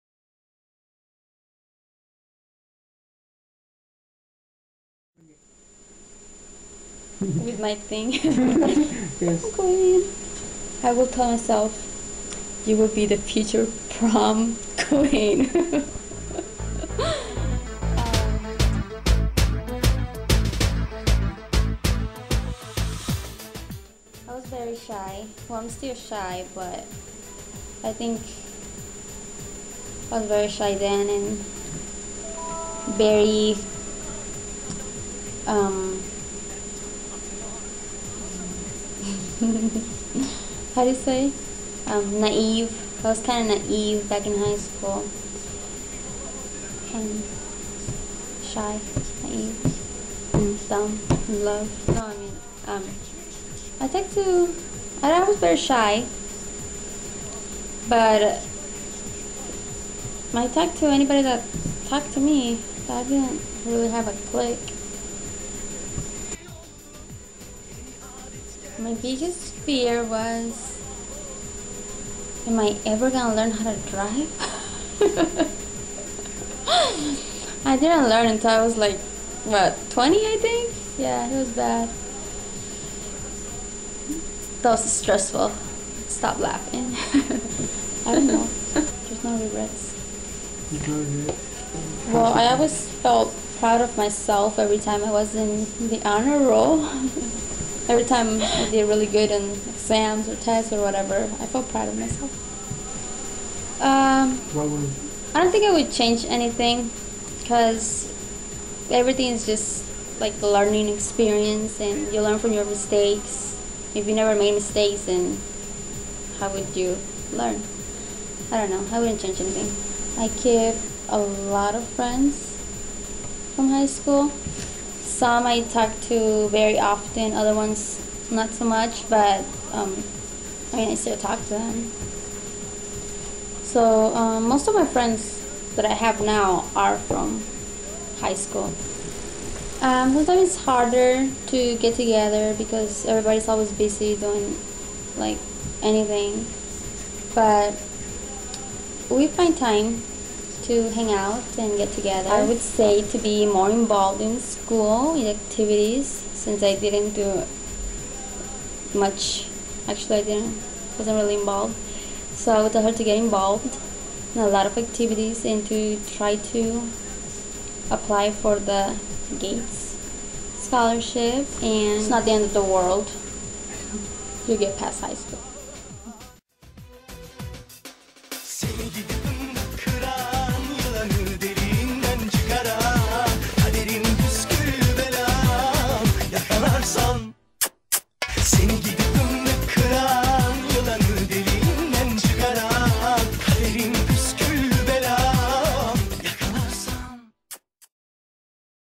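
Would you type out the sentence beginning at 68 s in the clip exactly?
my biggest fear was am I ever gonna learn how to drive?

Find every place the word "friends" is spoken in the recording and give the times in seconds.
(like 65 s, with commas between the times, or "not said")
121 s, 134 s.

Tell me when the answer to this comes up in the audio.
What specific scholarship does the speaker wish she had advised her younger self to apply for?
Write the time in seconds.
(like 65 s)
169 s.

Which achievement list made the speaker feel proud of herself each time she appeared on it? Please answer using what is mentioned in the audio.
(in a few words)
Honor roll.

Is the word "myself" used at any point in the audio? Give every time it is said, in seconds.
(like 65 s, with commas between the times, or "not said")
11 s, 93 s, 101 s.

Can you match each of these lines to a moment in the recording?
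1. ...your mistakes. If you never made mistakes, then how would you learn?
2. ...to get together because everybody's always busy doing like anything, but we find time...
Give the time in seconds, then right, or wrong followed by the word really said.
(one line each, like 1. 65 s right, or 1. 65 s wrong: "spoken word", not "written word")
1. 112 s right
2. 141 s right.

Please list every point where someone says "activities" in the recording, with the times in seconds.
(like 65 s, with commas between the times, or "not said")
155 s, 164 s.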